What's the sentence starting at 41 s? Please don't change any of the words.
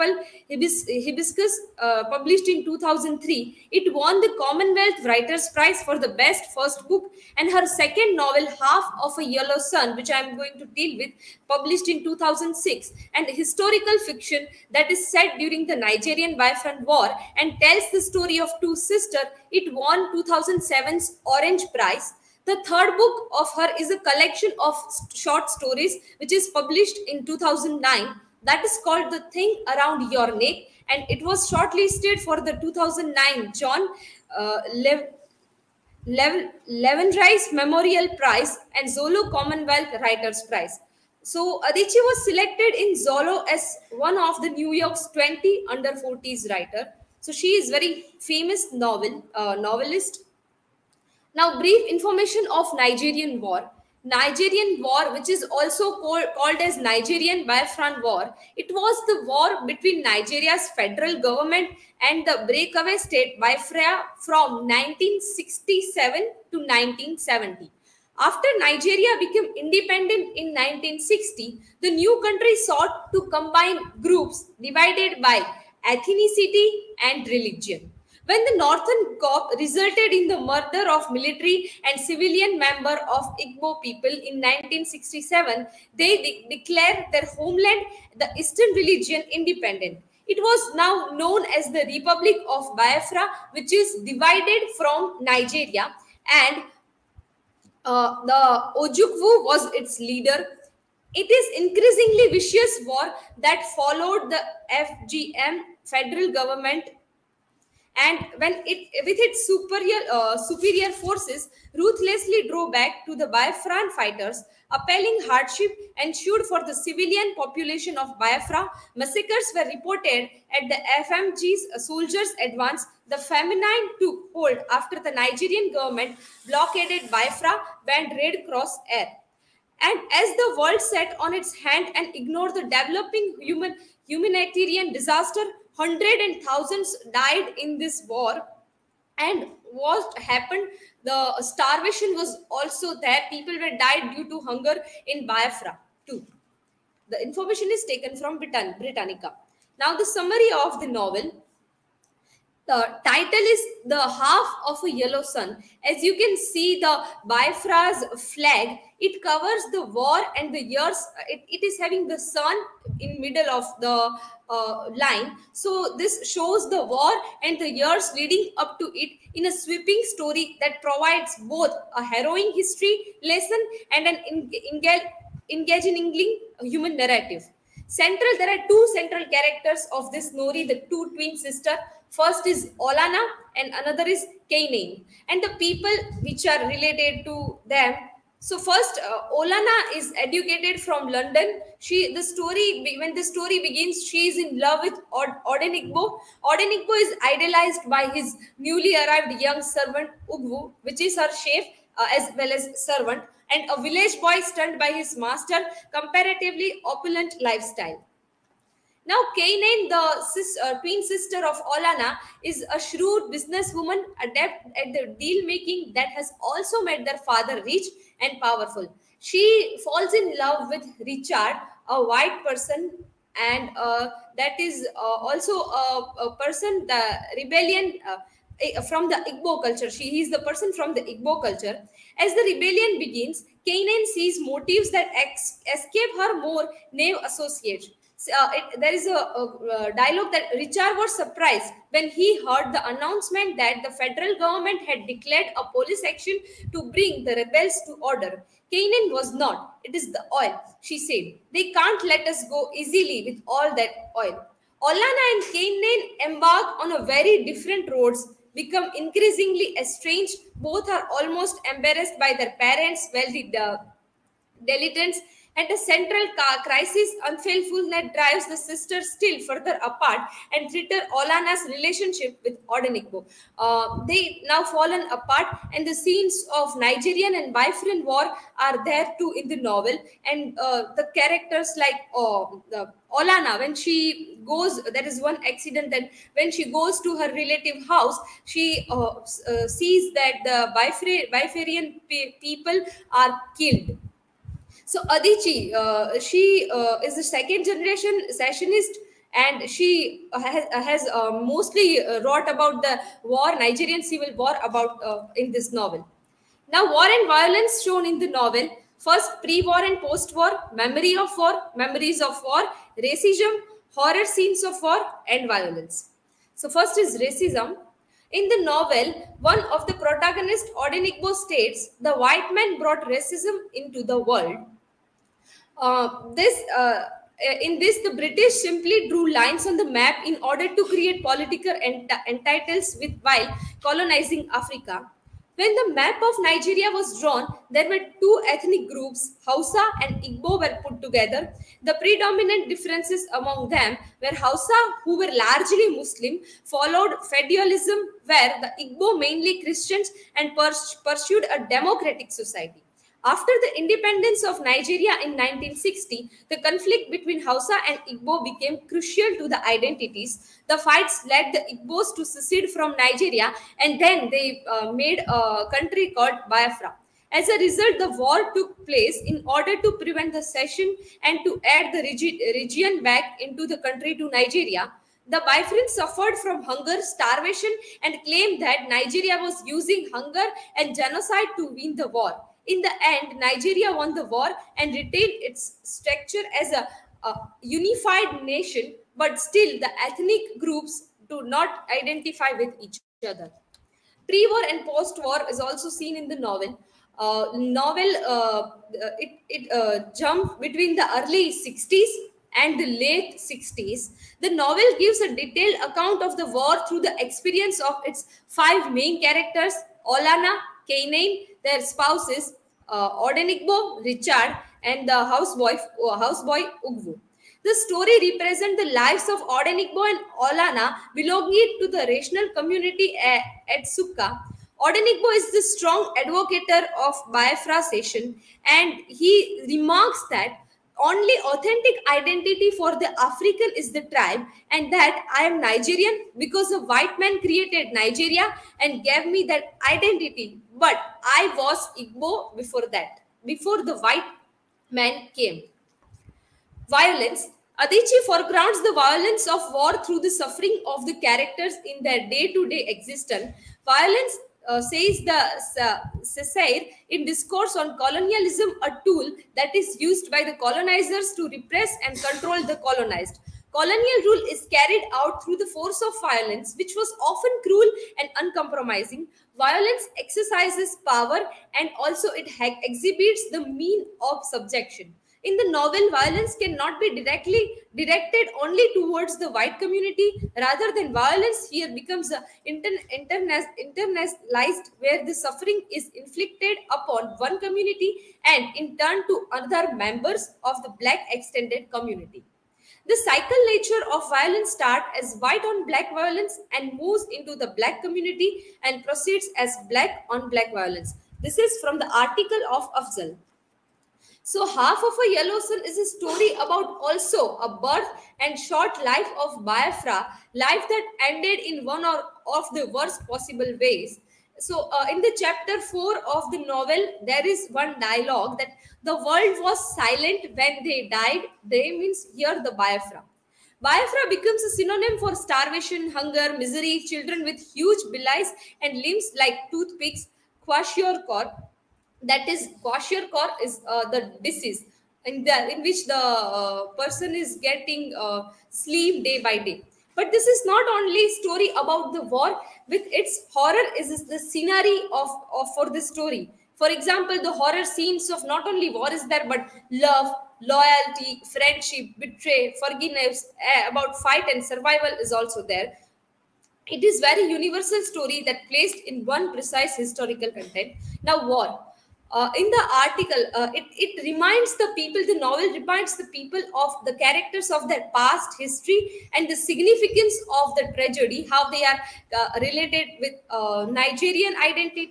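So Adichie was selected in Zolo as one of the New York's 20 under 40s writer.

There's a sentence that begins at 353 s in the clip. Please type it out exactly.
After the independence of Nigeria in 1960, the conflict between Hausa and Igbo became crucial to the identities.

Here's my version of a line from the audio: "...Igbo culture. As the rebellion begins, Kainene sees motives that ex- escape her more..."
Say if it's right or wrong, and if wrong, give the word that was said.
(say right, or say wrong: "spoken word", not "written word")
right.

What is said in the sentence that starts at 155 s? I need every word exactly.
As you can see, the Biafra's flag, it covers the war and the years.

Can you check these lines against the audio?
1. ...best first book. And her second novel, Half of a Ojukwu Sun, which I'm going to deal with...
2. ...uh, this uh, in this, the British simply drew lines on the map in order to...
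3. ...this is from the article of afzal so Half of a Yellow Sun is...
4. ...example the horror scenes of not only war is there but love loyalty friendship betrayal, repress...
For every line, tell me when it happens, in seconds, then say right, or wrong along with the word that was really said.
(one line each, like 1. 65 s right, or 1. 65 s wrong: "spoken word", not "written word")
1. 6 s wrong: "Yellow", not "Ojukwu"
2. 325 s right
3. 501 s right
4. 546 s wrong: "forgiveness", not "repress".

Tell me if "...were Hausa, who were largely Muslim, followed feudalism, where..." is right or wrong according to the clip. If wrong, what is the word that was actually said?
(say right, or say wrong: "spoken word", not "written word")
right.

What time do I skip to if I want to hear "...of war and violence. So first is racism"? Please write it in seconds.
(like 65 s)
314 s.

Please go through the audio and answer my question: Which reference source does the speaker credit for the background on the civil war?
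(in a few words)
Britannica.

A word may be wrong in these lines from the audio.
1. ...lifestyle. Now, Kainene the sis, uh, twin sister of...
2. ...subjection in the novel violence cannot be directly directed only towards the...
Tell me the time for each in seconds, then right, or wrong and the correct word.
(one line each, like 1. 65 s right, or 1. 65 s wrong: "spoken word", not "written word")
1. 207 s right
2. 474 s right.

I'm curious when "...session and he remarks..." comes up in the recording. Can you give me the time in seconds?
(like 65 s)
427 s.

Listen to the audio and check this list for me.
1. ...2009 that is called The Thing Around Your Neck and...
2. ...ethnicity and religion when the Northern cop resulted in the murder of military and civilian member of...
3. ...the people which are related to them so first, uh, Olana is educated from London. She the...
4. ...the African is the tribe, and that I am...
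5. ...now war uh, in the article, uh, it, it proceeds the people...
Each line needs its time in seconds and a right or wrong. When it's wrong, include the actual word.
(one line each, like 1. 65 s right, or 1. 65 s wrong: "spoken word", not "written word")
1. 27 s right
2. 75 s right
3. 185 s right
4. 432 s right
5. 561 s wrong: "reminds", not "proceeds".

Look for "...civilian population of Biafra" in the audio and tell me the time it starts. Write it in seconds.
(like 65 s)
116 s.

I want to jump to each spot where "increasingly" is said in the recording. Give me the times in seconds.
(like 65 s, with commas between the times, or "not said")
101 s, 258 s.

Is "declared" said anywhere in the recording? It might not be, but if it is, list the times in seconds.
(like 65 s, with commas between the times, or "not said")
86 s, 245 s.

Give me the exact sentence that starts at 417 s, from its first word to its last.
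The story represents the lives of Odenigbo and Olanna belonging to the rational community uh, at, at Nsukka.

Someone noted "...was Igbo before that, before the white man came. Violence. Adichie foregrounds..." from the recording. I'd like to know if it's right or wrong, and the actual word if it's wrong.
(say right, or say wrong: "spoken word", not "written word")
right.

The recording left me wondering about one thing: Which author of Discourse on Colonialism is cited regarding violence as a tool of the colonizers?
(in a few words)
Cesaire.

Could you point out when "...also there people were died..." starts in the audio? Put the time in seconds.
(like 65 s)
142 s.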